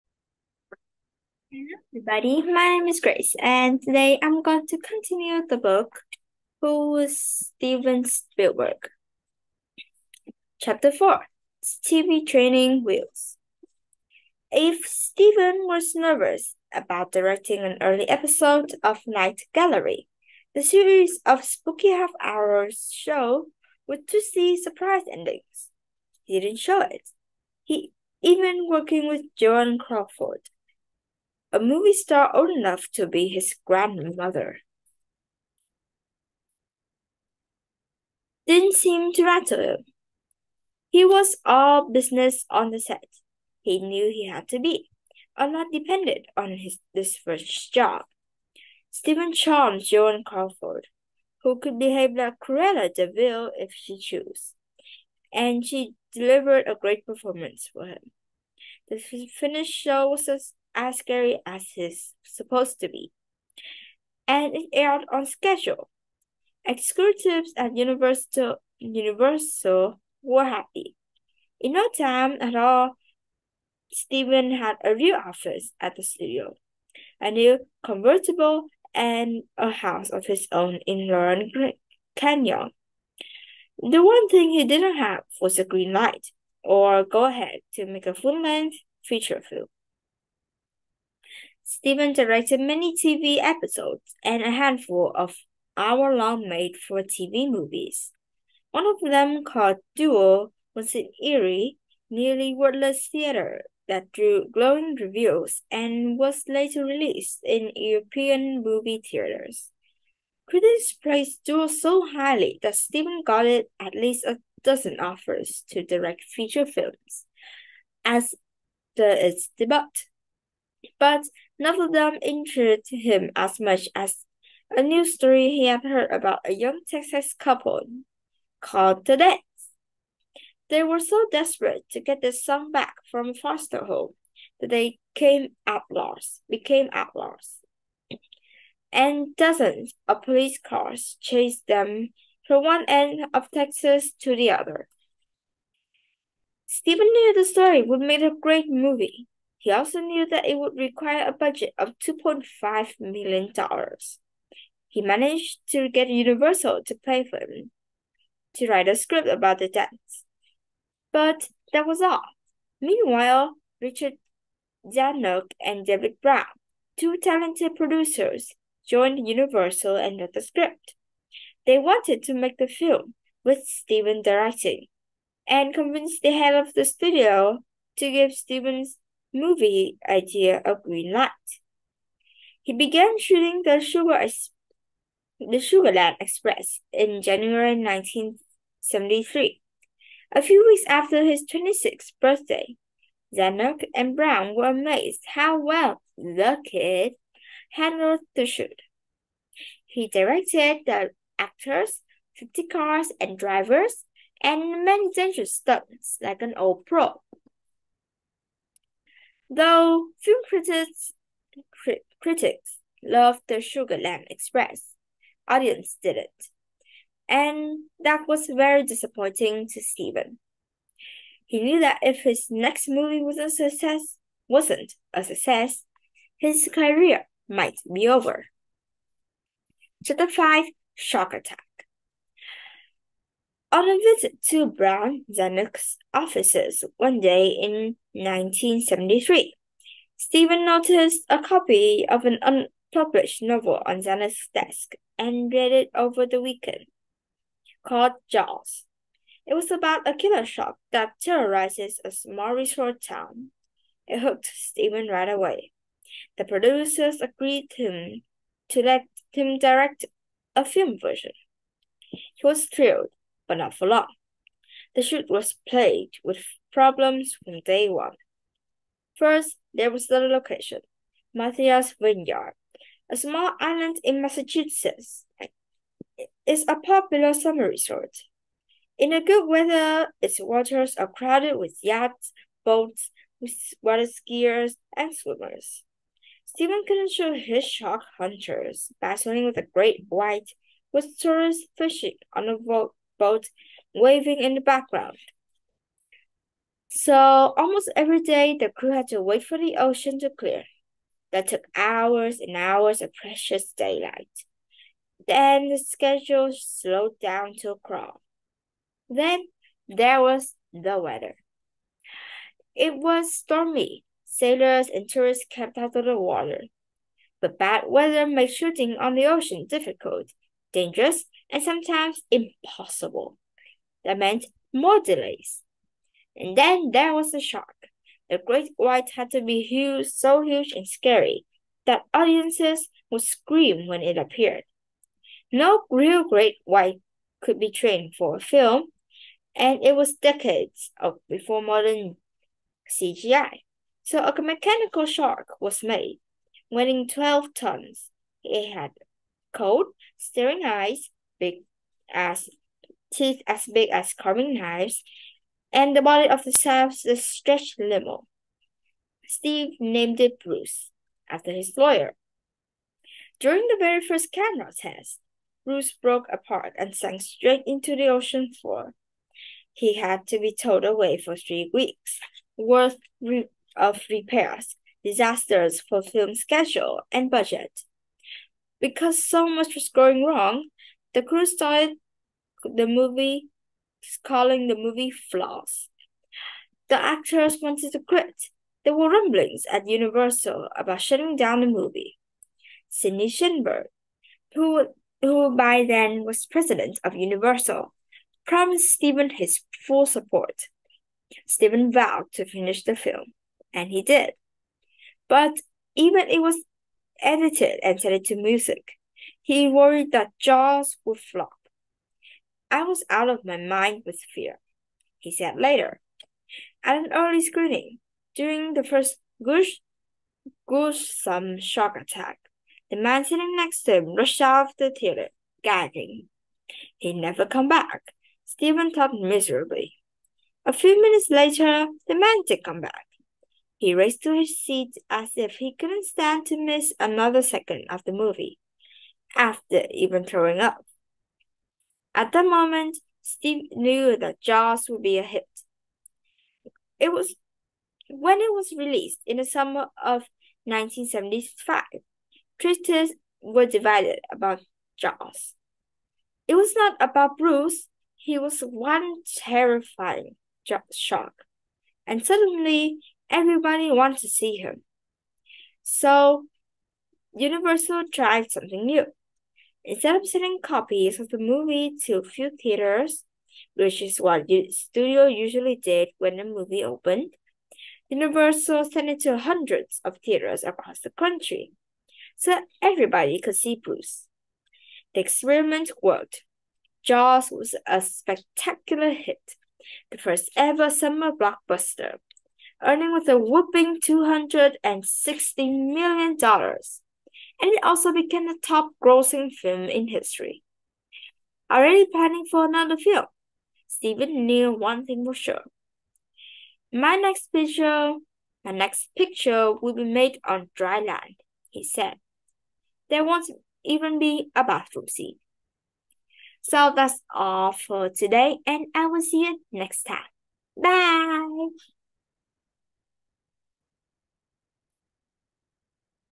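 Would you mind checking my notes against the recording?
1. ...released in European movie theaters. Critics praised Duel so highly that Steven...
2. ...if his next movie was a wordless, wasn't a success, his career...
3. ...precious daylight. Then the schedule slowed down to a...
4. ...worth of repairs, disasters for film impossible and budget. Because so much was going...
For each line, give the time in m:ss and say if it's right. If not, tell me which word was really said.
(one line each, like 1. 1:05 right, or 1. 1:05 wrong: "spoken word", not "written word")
1. 1:46 right
2. 3:42 wrong: "success", not "wordless"
3. 5:03 right
4. 6:12 wrong: "schedule", not "impossible".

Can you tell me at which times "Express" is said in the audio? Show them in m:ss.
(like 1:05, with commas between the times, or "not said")
3:06, 3:34.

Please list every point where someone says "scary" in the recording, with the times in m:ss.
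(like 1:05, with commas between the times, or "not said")
1:00, 5:30.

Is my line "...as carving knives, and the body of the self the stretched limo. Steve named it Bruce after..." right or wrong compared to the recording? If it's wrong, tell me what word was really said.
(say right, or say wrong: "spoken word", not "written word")
right.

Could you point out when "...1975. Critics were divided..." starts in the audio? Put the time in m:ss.
7:30.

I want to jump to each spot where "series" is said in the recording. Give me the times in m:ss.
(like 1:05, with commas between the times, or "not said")
0:20.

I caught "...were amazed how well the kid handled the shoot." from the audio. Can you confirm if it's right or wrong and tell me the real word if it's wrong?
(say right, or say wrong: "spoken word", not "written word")
right.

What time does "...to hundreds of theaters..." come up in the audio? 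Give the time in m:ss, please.
7:59.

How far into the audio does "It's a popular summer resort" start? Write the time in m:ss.
4:36.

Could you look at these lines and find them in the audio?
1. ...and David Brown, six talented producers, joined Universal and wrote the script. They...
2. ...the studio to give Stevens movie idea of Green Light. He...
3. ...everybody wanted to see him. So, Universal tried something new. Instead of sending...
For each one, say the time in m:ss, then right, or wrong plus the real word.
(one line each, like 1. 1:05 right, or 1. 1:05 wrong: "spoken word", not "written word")
1. 2:45 wrong: "two", not "six"
2. 2:56 right
3. 7:43 right.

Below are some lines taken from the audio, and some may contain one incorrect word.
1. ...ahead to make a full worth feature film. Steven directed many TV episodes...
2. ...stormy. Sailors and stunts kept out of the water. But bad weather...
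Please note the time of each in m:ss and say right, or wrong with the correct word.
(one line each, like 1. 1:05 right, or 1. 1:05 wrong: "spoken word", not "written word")
1. 1:27 wrong: "length", not "worth"
2. 5:13 wrong: "tourists", not "stunts".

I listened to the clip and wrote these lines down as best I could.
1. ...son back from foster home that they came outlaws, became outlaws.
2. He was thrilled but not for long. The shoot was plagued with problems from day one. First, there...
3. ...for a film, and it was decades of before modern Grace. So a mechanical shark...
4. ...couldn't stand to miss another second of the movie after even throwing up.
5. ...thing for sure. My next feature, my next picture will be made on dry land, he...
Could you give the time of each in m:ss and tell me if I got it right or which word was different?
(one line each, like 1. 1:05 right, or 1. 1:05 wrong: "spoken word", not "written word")
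1. 2:12 right
2. 4:22 right
3. 5:38 wrong: "CGI", not "Grace"
4. 7:15 right
5. 8:25 wrong: "picture", not "feature".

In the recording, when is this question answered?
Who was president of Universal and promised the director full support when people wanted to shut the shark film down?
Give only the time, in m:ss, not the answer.
6:32.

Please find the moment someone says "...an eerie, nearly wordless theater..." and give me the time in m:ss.
1:40.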